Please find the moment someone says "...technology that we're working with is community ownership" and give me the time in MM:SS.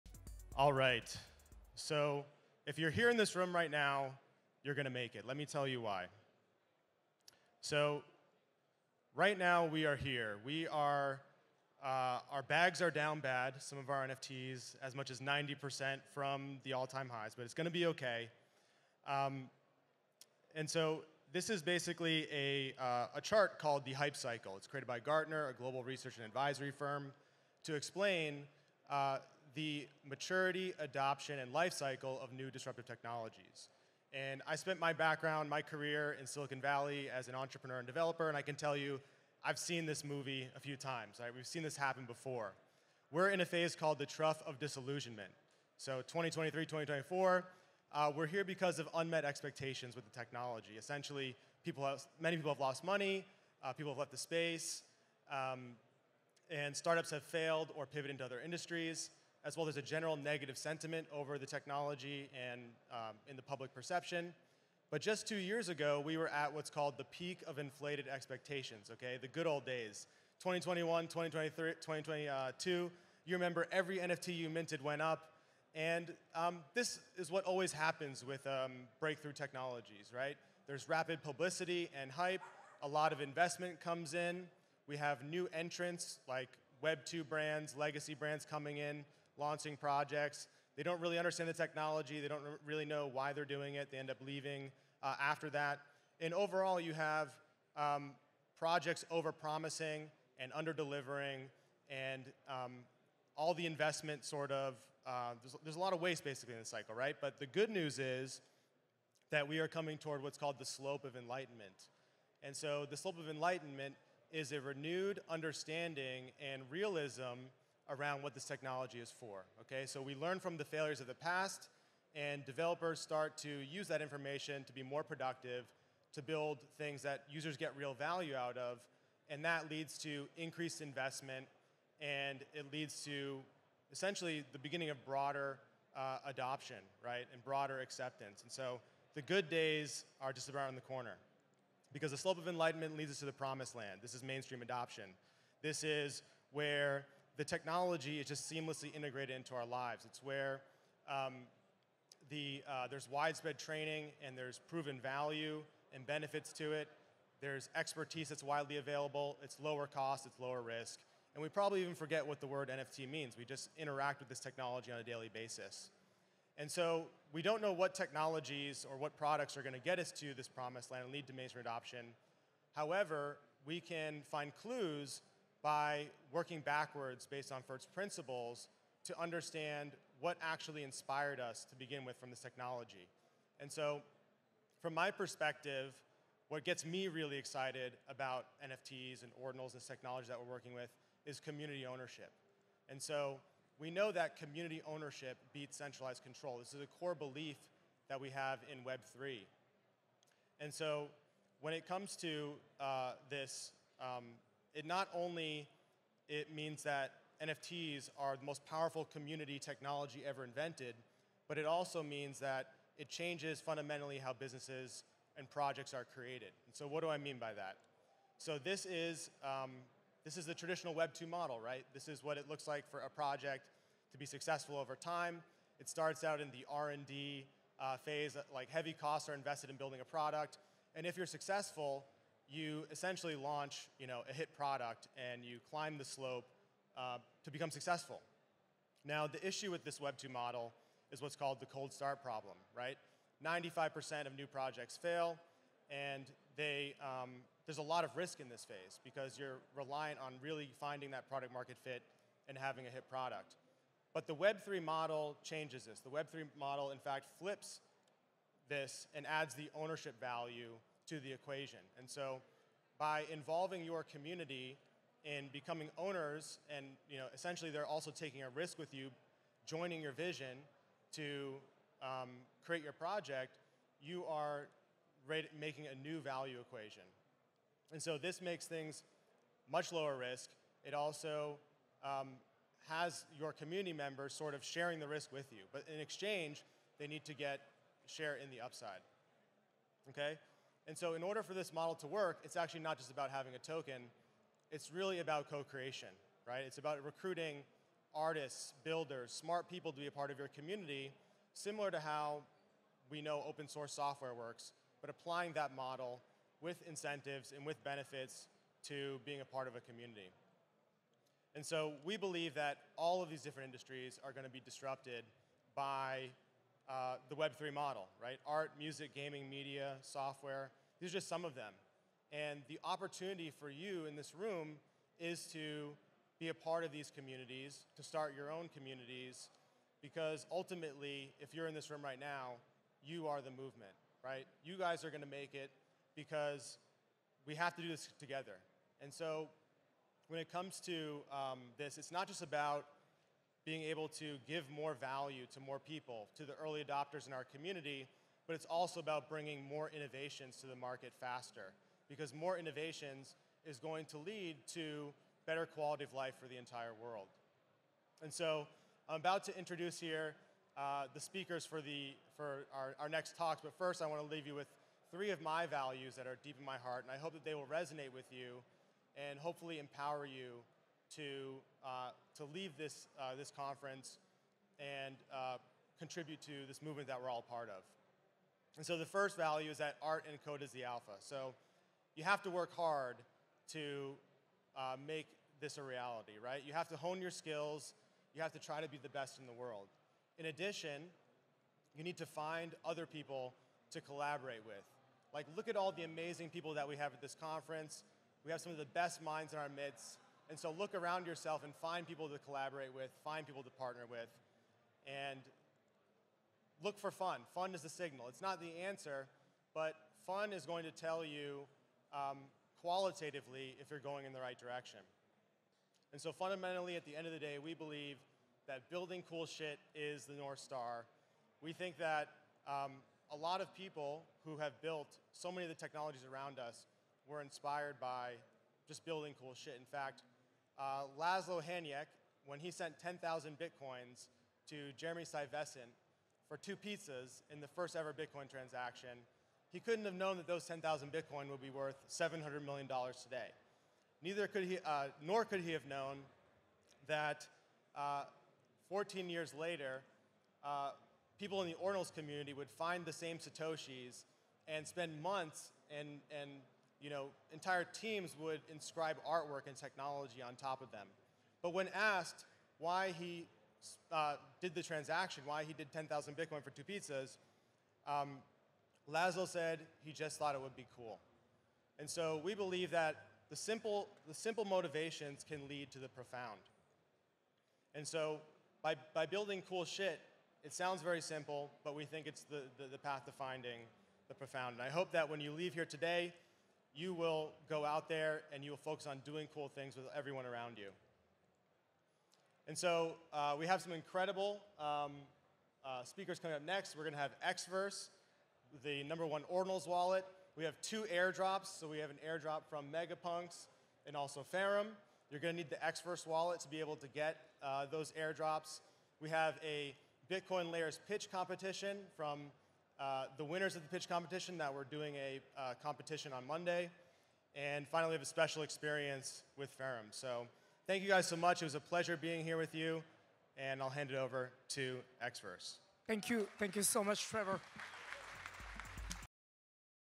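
03:09.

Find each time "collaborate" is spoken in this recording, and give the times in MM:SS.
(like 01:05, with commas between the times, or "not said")
06:34, 06:42.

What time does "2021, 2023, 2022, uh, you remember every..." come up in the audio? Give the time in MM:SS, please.
01:10.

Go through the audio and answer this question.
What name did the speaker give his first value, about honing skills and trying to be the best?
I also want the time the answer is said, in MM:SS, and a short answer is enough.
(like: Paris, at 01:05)
art and code is the alpha, at 06:20.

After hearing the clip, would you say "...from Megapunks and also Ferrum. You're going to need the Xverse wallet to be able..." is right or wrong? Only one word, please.
right.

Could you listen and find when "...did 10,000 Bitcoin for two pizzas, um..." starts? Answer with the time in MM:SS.
07:45.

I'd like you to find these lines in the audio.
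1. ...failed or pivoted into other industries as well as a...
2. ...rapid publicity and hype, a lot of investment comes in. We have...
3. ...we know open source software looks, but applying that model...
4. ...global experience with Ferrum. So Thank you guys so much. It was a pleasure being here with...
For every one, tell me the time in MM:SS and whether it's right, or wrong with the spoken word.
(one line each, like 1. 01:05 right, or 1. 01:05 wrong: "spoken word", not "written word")
1. 00:57 right
2. 01:20 right
3. 05:03 wrong: "works", not "looks"
4. 08:38 wrong: "special", not "global".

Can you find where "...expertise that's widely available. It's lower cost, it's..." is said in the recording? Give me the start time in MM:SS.
02:37.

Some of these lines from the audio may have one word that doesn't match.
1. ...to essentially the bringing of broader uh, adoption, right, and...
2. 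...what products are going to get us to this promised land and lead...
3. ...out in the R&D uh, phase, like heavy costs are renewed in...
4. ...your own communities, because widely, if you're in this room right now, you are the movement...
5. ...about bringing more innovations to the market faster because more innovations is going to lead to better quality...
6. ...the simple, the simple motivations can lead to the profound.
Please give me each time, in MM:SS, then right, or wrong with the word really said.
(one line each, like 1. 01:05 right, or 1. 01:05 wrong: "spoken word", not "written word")
1. 02:13 wrong: "beginning", not "bringing"
2. 02:48 right
3. 03:46 wrong: "invested", not "renewed"
4. 05:28 wrong: "ultimately", not "widely"
5. 05:48 right
6. 07:53 right.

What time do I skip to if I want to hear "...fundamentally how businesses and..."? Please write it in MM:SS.
03:33.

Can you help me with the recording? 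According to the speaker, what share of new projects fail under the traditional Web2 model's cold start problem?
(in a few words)
95%.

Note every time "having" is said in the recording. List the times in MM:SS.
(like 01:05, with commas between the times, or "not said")
04:12, 04:53.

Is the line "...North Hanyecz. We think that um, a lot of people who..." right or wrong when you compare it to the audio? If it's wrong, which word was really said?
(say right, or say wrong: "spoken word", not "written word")
wrong: "Star", not "Hanyecz".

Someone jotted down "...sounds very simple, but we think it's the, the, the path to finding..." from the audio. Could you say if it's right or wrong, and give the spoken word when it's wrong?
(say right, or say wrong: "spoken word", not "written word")
right.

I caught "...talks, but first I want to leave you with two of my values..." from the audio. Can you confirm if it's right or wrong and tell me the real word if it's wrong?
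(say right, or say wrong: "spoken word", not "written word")
wrong: "three", not "two".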